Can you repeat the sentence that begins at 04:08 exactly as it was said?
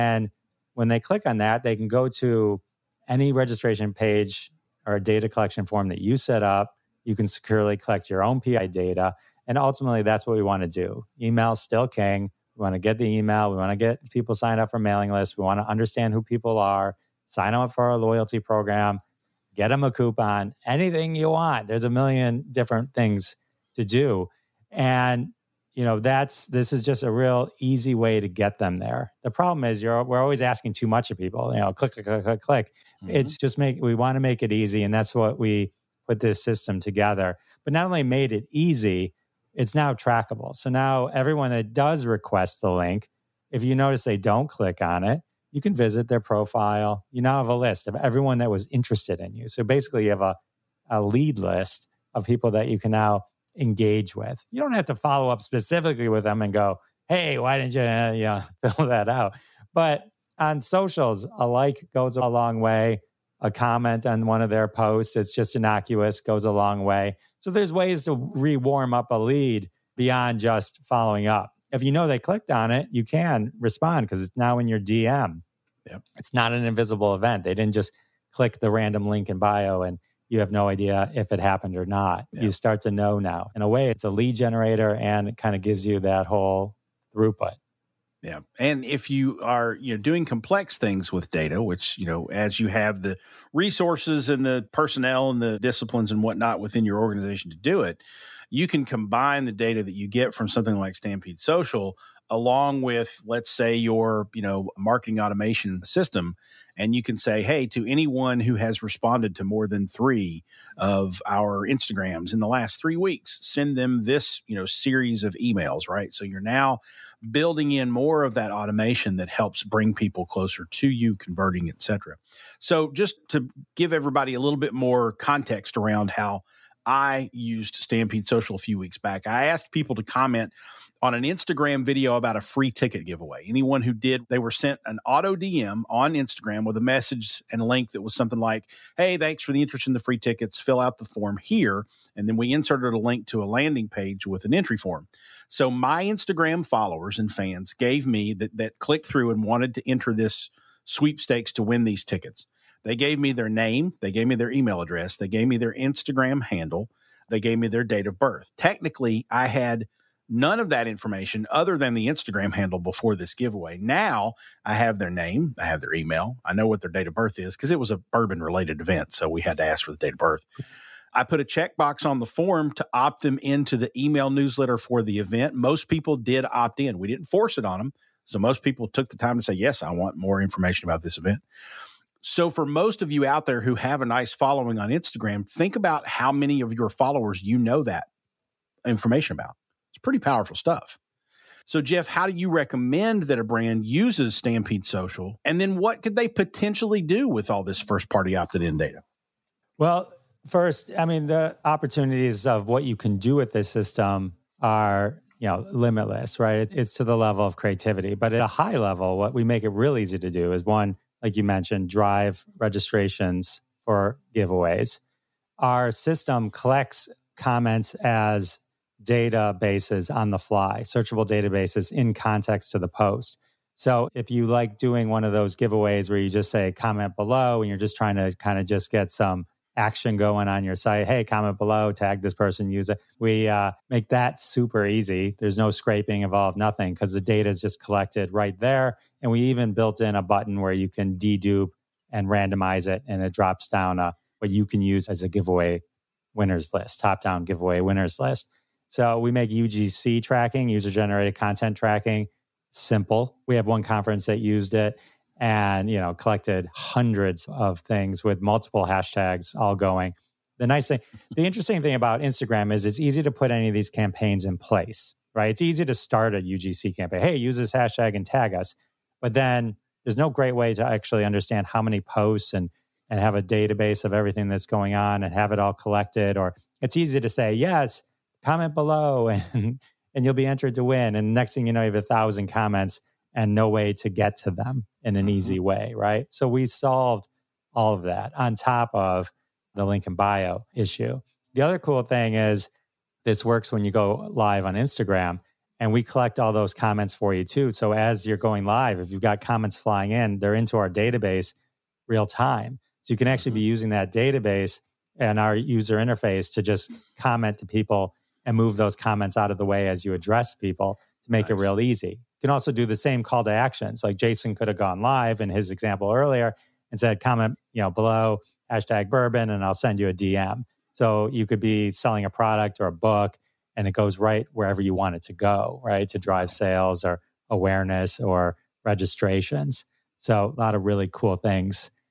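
So we make UGC tracking, user generated content tracking, simple.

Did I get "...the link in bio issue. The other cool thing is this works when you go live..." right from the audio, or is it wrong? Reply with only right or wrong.
right.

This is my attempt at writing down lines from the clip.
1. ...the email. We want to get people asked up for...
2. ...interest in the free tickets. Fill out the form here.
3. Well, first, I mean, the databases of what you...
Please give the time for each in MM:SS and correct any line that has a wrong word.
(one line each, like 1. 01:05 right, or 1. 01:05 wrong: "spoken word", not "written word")
1. 00:12 wrong: "signed", not "asked"
2. 02:19 right
3. 03:19 wrong: "opportunities", not "databases".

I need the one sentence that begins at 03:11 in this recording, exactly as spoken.
So, Jeff, how do you recommend that a brand uses Stampede Social?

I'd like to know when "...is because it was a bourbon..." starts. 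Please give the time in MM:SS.
02:47.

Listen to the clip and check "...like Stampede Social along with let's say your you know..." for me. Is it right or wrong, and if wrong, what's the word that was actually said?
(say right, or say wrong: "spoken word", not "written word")
right.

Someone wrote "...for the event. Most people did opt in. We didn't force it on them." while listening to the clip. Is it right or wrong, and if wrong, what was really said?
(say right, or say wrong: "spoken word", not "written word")
right.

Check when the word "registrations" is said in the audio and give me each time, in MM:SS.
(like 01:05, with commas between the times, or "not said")
00:03, 03:32, 05:28.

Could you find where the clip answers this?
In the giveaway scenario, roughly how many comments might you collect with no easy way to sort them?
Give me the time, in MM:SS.
04:41.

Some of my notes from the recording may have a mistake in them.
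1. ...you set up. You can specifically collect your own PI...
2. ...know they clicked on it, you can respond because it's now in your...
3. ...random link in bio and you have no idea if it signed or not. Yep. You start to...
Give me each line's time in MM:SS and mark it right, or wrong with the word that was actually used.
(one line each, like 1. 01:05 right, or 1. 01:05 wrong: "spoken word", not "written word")
1. 00:05 wrong: "securely", not "specifically"
2. 01:11 right
3. 01:18 wrong: "happened", not "signed".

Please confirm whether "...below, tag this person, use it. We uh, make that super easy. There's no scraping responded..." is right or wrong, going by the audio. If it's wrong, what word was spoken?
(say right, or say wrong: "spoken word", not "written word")
wrong: "involved", not "responded".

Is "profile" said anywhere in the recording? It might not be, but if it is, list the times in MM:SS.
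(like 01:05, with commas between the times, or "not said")
00:46.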